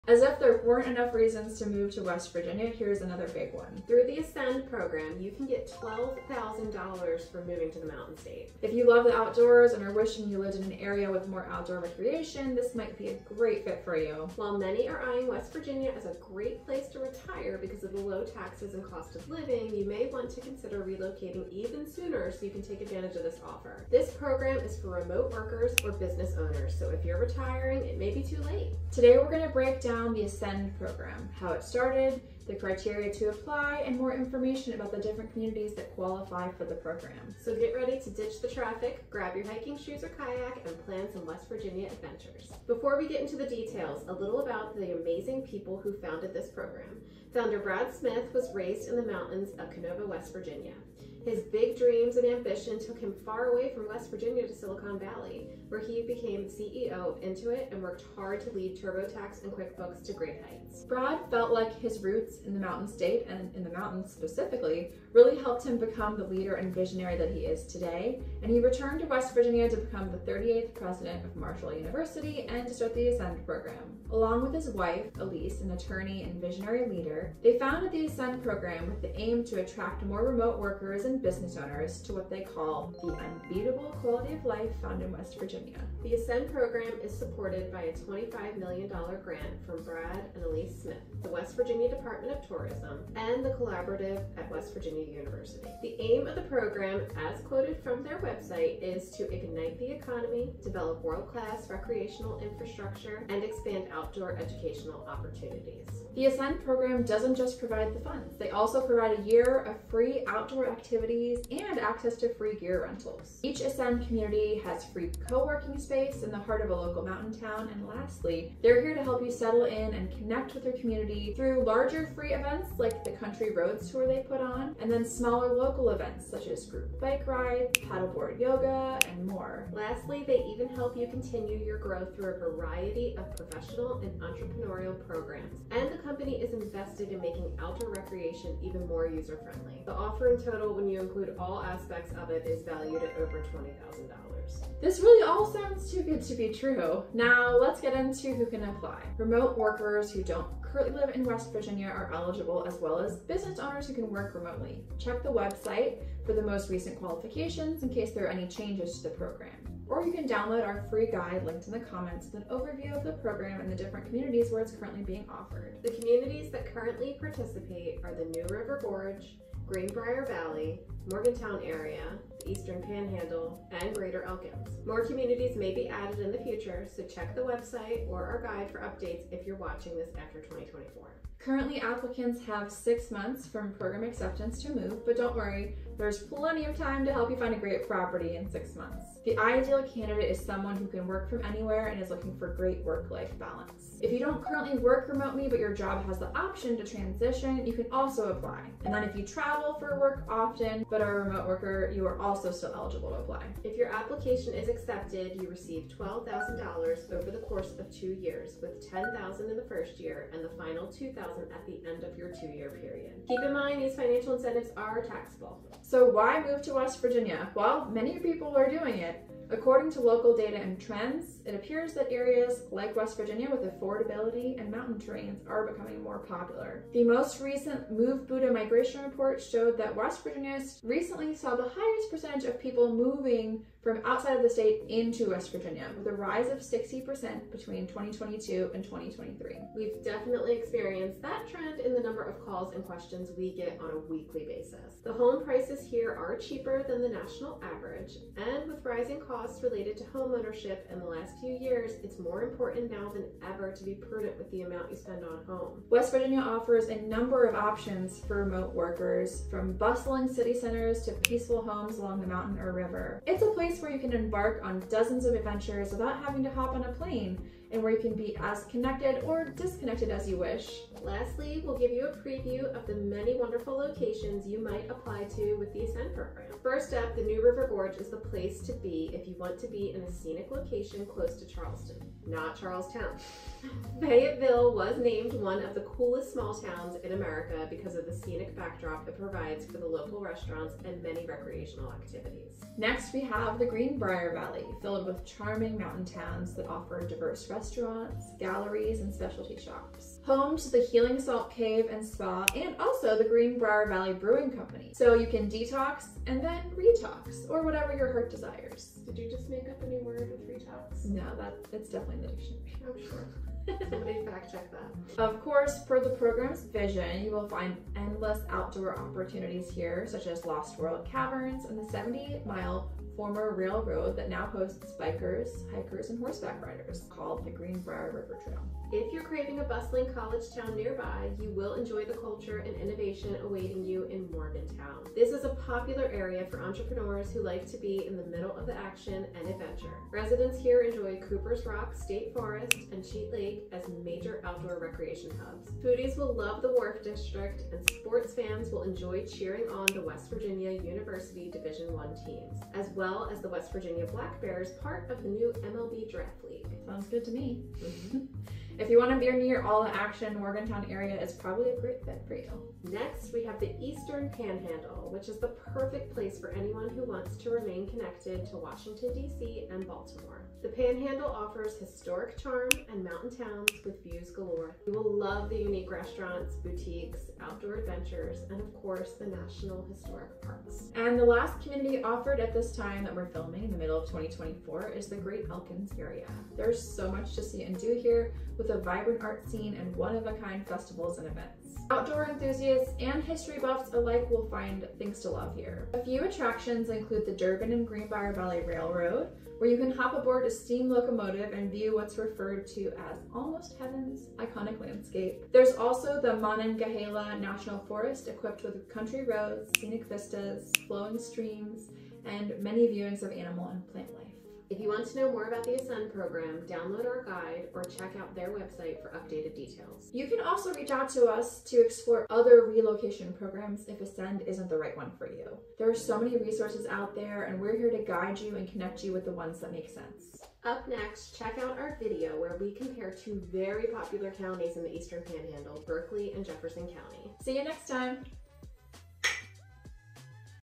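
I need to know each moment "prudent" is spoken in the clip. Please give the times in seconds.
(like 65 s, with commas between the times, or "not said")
253 s.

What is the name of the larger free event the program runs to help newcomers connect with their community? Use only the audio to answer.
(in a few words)
Country Roads Tour.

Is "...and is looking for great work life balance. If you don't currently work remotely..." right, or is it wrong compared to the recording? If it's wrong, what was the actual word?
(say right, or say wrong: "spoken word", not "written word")
right.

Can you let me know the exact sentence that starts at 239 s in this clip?
We've definitely experienced that trend in the number of calls and questions we get on a weekly basis.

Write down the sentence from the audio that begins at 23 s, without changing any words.
This program is for remote workers or business owners, so if you're retiring, it may be too late.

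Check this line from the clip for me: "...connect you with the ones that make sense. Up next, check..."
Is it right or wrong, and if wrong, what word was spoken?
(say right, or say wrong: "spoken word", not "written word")
right.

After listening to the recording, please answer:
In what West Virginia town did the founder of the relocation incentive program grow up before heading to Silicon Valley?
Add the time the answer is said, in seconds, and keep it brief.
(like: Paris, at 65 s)
Kenova, at 49 s.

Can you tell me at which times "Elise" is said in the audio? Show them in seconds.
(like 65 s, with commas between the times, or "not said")
75 s, 90 s.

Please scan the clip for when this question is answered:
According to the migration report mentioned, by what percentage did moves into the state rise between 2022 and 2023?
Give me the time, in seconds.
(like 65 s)
236 s.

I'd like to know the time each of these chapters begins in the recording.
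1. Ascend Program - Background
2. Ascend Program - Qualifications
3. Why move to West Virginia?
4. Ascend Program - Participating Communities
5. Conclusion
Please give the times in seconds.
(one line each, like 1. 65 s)
1. 43 s
2. 145 s
3. 216 s
4. 271 s
5. 431 s.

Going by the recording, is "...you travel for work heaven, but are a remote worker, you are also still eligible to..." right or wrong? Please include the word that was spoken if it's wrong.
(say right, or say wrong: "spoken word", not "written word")
wrong: "often", not "heaven".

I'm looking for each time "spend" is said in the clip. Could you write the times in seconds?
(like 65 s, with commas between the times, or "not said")
254 s.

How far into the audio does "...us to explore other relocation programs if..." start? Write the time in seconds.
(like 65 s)
421 s.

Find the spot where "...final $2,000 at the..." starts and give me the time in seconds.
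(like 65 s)
210 s.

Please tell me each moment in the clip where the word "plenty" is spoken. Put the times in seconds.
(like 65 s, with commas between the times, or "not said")
186 s.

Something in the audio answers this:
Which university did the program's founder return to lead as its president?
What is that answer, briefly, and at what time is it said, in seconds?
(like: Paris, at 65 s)
Marshall University, at 71 s.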